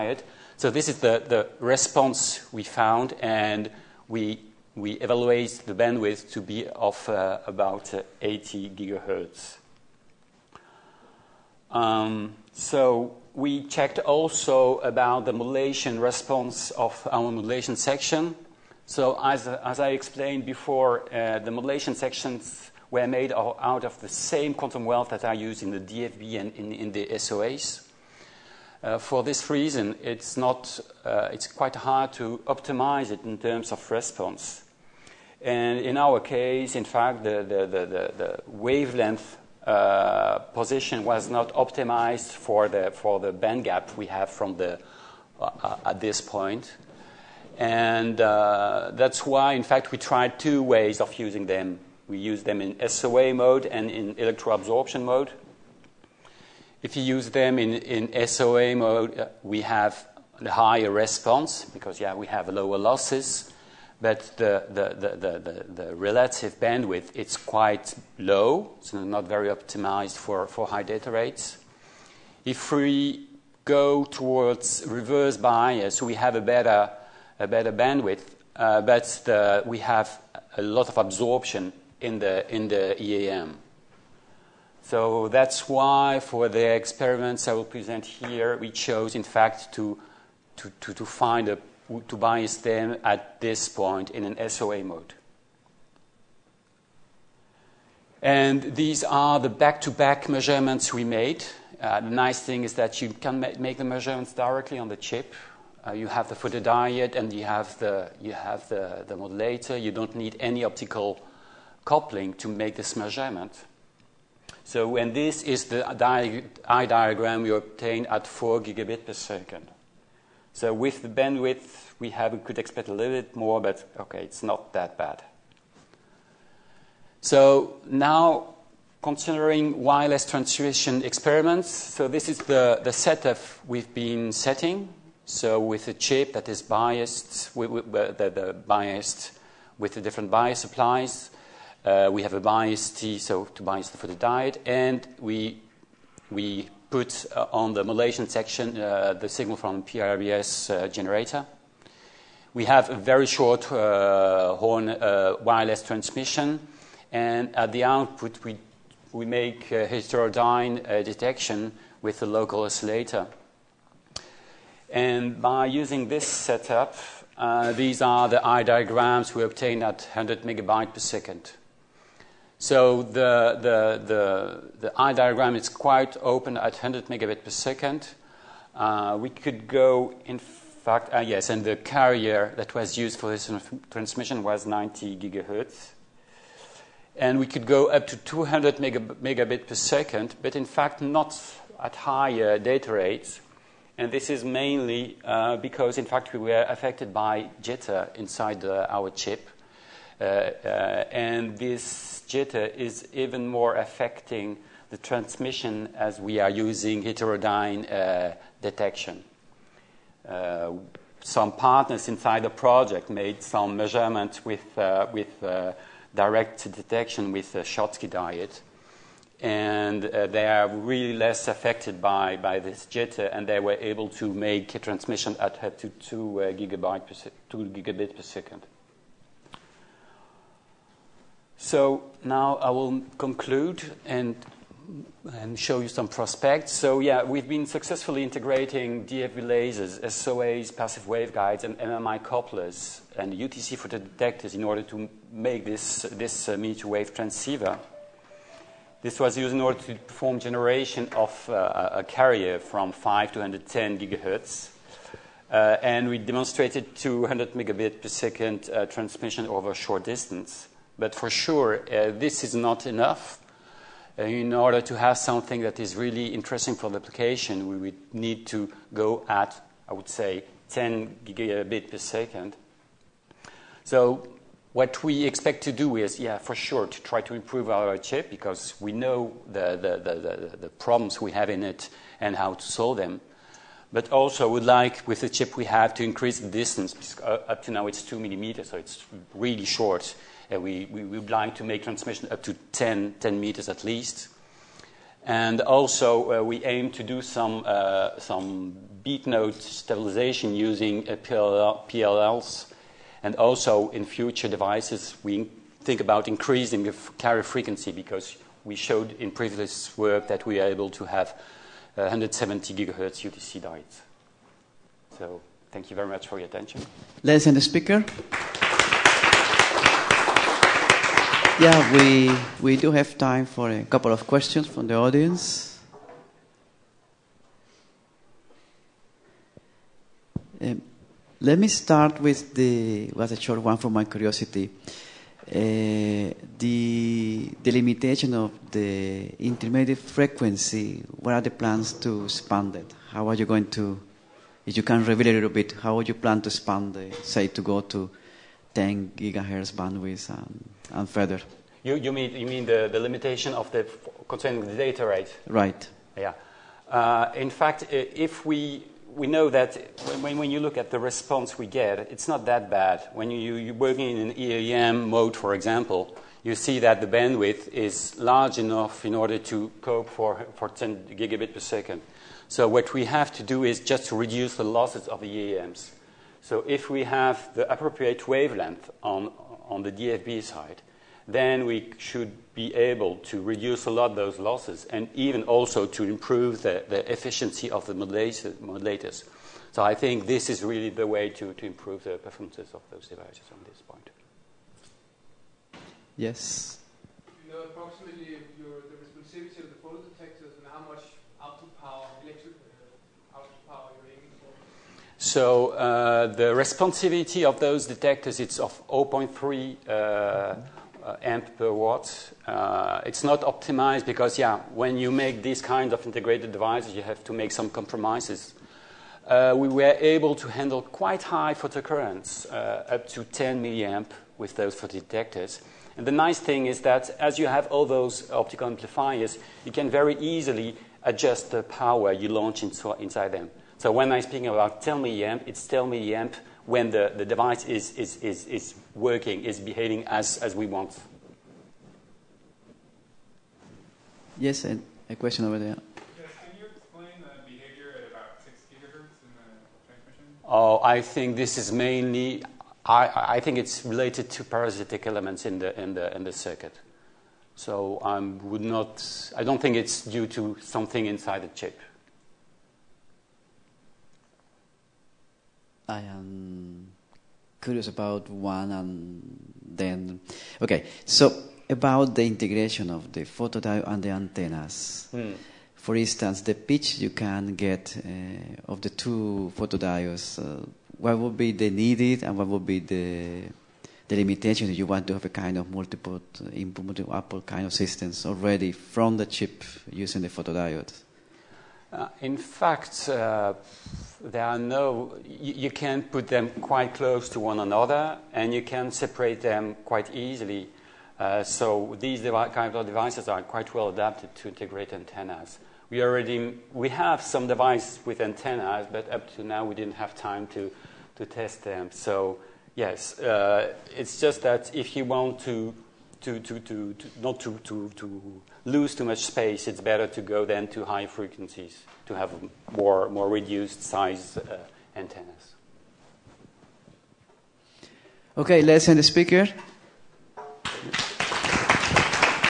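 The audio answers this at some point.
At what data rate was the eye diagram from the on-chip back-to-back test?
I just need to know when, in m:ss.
1:58.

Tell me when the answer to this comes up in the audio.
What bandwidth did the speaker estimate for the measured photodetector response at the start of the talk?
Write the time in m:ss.
0:08.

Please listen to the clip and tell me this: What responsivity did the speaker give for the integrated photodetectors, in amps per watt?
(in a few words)
0.3 A/W.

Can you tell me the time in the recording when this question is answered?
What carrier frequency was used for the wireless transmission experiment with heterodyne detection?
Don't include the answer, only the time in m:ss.
3:04.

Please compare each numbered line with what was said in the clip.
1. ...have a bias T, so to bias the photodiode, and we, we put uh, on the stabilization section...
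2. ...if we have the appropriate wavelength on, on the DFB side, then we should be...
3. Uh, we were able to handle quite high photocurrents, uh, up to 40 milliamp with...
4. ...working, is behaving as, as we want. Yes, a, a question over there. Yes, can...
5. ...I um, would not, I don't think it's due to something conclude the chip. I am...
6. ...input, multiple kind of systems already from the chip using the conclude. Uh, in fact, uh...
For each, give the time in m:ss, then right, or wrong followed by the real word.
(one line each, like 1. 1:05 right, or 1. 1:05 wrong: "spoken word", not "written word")
1. 2:22 wrong: "modulation", not "stabilization"
2. 6:16 right
3. 6:59 wrong: "10", not "40"
4. 7:18 right
5. 7:38 wrong: "inside", not "conclude"
6. 8:06 wrong: "photodiode", not "conclude".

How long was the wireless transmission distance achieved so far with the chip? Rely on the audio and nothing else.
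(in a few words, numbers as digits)
2 millimeters.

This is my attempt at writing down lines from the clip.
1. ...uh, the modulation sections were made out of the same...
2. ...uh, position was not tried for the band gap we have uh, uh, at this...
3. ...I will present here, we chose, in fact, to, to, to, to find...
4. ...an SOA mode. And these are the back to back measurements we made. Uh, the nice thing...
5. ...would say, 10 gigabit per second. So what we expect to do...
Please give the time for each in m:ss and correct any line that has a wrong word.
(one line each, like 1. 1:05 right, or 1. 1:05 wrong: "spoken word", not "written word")
1. 0:21 right
2. 0:39 wrong: "optimized", not "tried"
3. 1:27 right
4. 1:34 right
5. 4:29 right.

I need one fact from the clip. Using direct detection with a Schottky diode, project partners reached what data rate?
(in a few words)
2 Gbit/s.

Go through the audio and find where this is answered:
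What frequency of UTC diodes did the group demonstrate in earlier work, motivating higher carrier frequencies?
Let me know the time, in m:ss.
5:11.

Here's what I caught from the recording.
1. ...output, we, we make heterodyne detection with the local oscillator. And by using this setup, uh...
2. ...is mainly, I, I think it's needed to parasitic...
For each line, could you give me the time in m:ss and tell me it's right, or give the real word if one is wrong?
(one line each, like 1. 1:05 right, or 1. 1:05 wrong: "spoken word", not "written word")
1. 2:37 right
2. 7:31 wrong: "related", not "needed".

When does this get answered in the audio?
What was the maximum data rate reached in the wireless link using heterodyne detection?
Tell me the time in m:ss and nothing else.
3:08.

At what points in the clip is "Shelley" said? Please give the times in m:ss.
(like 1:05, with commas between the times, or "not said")
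not said.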